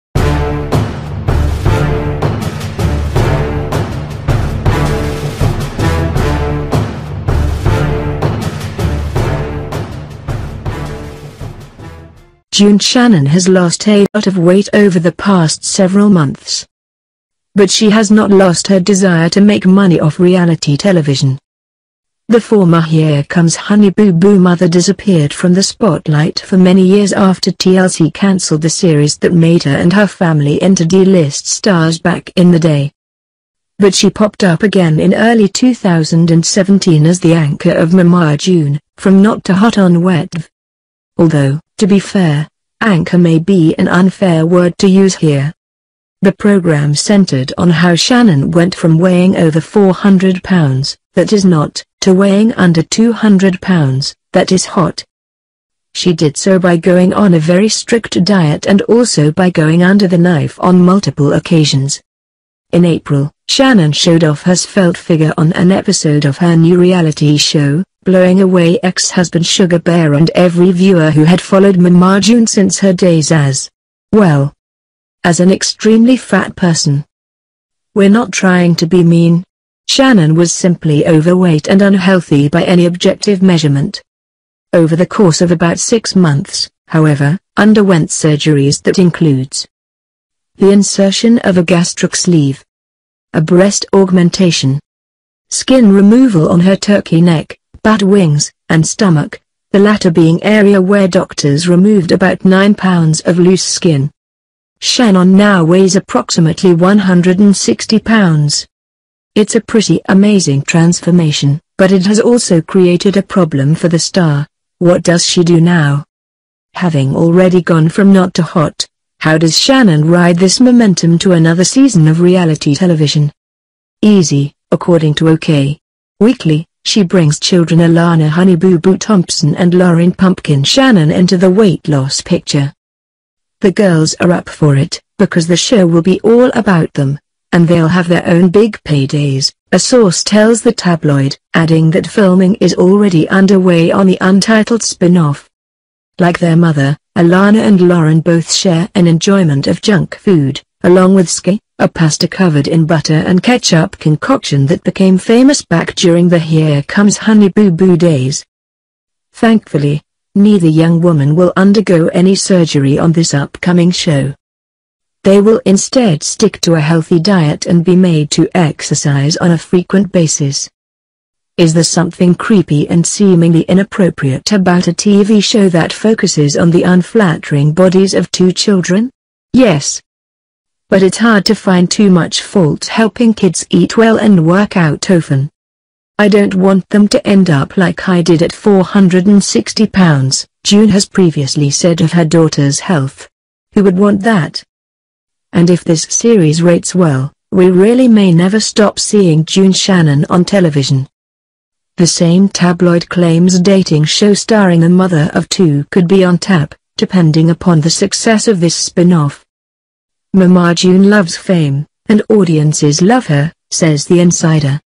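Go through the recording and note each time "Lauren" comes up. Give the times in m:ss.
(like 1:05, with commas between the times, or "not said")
2:09, 2:27.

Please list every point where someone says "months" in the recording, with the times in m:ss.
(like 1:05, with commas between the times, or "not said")
0:16, 1:26.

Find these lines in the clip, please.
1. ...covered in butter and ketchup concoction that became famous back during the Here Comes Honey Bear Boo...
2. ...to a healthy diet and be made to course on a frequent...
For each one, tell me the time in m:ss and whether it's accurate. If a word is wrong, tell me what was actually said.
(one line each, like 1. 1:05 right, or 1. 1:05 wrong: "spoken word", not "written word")
1. 2:32 wrong: "Boo", not "Bear"
2. 2:46 wrong: "exercise", not "course".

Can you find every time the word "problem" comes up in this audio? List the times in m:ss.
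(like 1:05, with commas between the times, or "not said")
1:53.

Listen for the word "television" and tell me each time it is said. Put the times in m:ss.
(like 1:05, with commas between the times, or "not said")
0:20, 2:02, 3:20.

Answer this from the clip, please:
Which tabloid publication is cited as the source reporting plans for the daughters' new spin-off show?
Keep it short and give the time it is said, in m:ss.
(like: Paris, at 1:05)
OK Weekly, at 2:05.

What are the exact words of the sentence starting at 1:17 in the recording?
We're not trying to be mean.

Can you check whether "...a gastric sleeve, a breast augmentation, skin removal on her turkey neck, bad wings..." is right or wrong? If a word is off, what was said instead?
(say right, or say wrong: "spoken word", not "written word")
right.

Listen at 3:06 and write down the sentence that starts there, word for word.
I don't want them to end up like I did at 460 pounds, June has previously said of her daughter's health.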